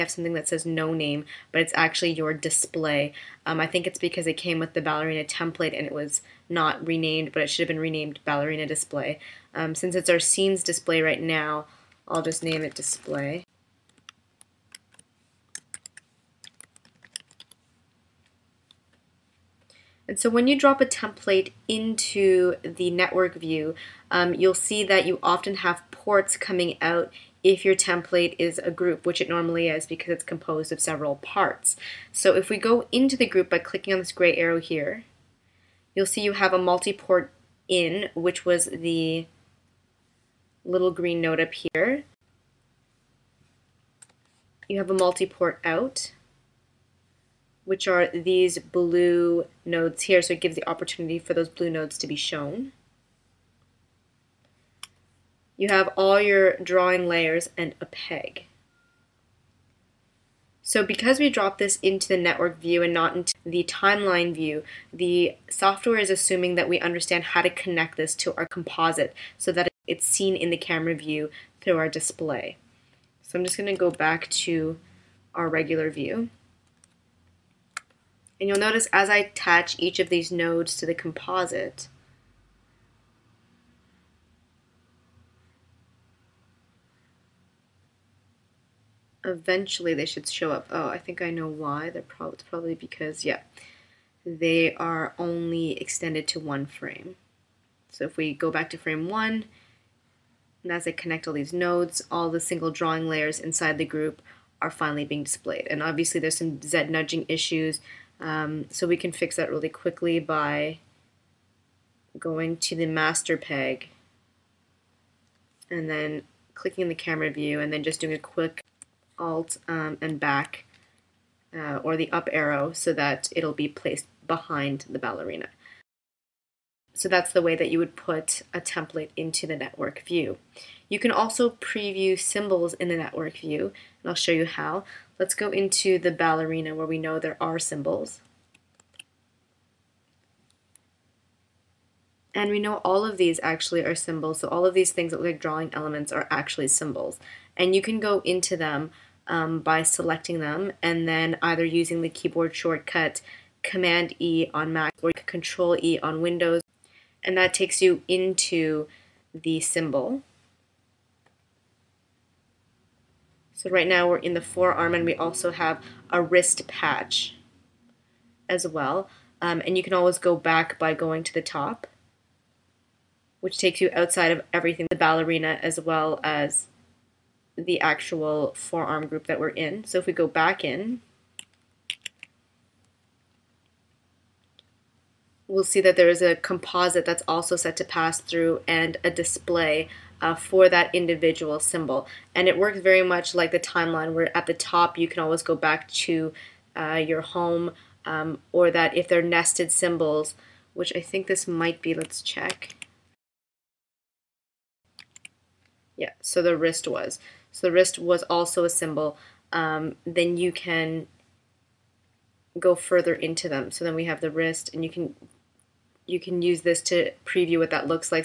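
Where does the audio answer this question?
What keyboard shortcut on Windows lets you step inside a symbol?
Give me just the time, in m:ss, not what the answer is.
2:35.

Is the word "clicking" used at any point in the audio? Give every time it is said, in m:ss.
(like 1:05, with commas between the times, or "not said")
0:33, 1:56.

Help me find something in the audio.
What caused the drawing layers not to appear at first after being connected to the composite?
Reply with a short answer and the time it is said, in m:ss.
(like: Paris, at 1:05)
extended to one frame, at 1:34.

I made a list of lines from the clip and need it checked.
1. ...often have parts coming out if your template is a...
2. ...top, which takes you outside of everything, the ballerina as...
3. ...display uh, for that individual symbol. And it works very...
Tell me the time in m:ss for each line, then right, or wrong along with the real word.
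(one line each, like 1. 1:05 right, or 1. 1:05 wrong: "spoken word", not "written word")
1. 0:25 wrong: "ports", not "parts"
2. 2:51 right
3. 3:09 right.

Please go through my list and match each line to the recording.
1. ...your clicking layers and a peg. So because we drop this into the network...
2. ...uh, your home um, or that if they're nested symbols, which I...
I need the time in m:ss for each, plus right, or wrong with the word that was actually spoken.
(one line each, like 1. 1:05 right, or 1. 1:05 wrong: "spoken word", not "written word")
1. 0:56 wrong: "drawing", not "clicking"
2. 3:16 right.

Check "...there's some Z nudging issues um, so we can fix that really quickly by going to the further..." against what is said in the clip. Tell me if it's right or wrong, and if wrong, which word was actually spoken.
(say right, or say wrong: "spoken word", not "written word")
wrong: "master", not "further".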